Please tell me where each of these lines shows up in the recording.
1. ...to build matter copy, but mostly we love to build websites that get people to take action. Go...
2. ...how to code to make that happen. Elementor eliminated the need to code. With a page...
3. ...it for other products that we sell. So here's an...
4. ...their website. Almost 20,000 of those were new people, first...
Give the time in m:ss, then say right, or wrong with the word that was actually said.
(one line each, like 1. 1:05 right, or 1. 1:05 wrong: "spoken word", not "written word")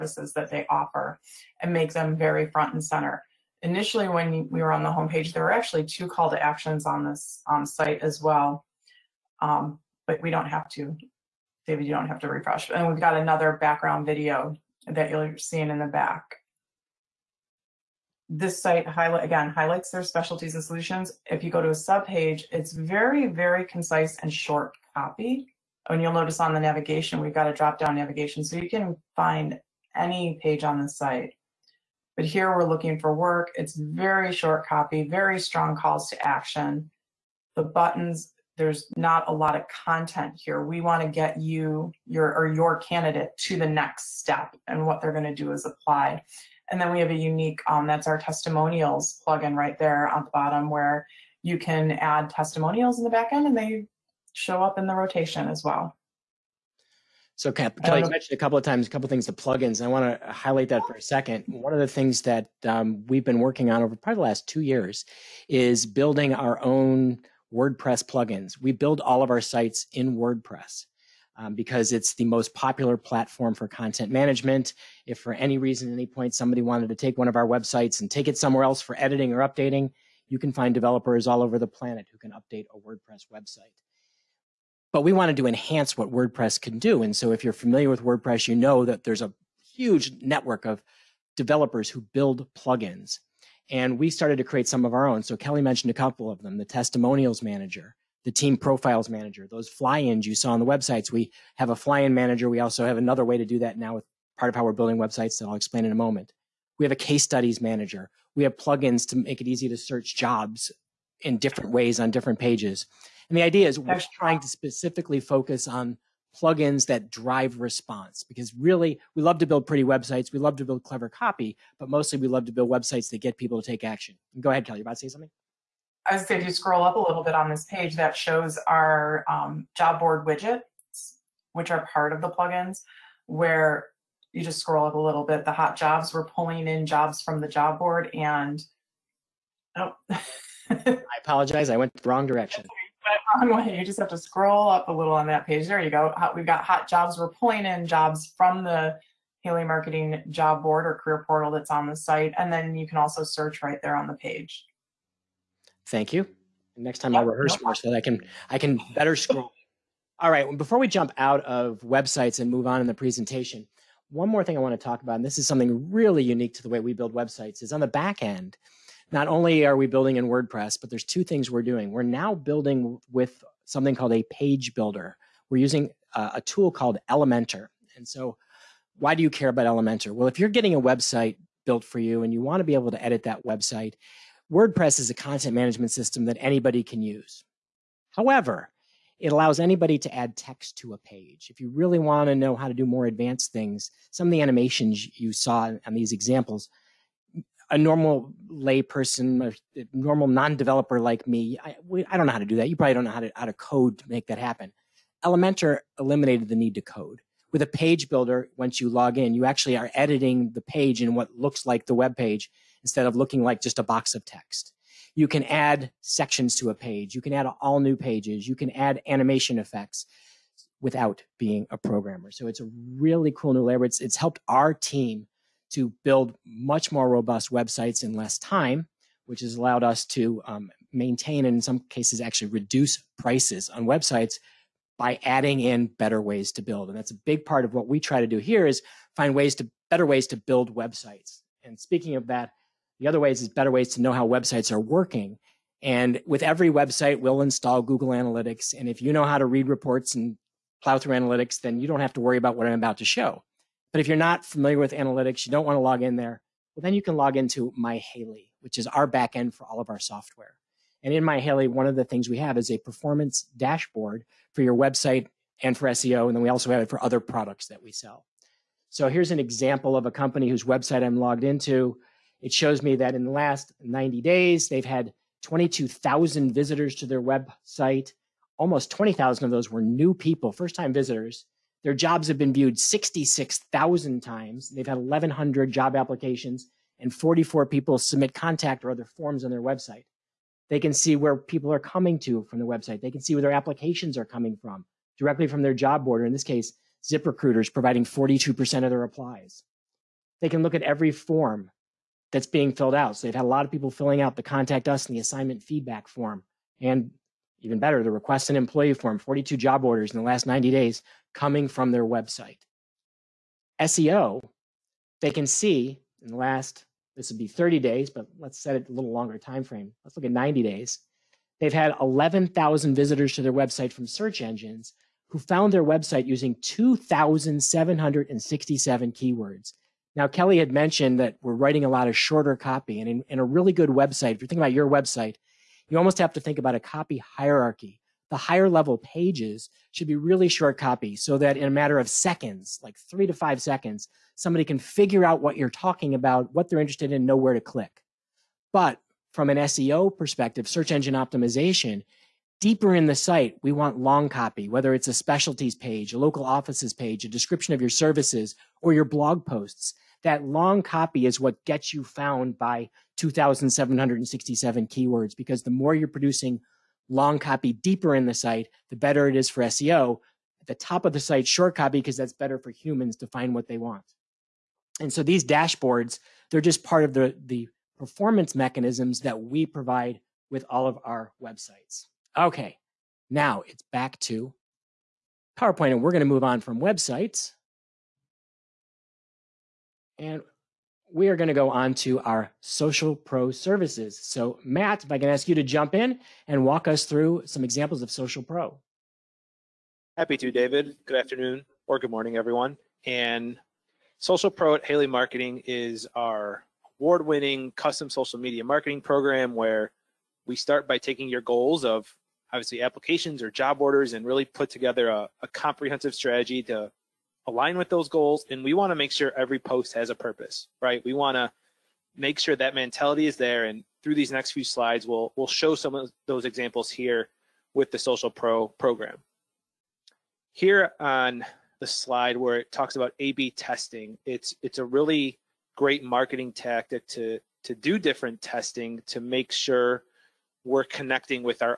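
1. 2:00 wrong: "clever", not "matter"
2. 3:23 right
3. 4:26 right
4. 4:37 right.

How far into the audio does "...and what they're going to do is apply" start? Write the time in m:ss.
0:44.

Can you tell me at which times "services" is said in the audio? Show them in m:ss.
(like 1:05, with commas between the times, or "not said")
5:57, 6:33.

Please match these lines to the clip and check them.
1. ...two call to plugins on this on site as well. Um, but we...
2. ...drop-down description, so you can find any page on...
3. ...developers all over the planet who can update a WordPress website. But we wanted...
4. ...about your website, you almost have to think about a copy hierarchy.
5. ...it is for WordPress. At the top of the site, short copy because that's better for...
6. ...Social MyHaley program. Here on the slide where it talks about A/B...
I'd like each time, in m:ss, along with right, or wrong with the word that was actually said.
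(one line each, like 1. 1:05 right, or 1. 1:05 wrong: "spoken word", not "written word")
1. 0:05 wrong: "actions", not "plugins"
2. 0:27 wrong: "navigation", not "description"
3. 1:20 right
4. 5:34 right
5. 6:09 wrong: "SEO", not "WordPress"
6. 7:07 wrong: "Pro", not "MyHaley".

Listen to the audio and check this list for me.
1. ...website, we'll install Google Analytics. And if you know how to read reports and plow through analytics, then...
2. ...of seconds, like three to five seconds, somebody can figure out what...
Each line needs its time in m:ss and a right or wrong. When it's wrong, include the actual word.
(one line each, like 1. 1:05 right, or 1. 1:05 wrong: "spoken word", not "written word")
1. 4:06 right
2. 5:41 right.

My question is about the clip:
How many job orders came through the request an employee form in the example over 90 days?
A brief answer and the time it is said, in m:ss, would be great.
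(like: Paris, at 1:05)
42, at 5:09.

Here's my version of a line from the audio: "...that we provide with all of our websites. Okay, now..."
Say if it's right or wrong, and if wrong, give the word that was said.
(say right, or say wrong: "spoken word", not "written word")
right.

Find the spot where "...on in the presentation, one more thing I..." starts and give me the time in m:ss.
2:42.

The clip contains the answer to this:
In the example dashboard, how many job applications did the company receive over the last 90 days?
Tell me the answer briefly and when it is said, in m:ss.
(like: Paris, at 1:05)
1,100, at 4:44.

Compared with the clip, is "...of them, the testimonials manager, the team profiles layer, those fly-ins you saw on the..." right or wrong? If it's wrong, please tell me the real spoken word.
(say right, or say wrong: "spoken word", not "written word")
wrong: "manager", not "layer".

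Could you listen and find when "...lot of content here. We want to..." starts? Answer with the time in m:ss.
0:39.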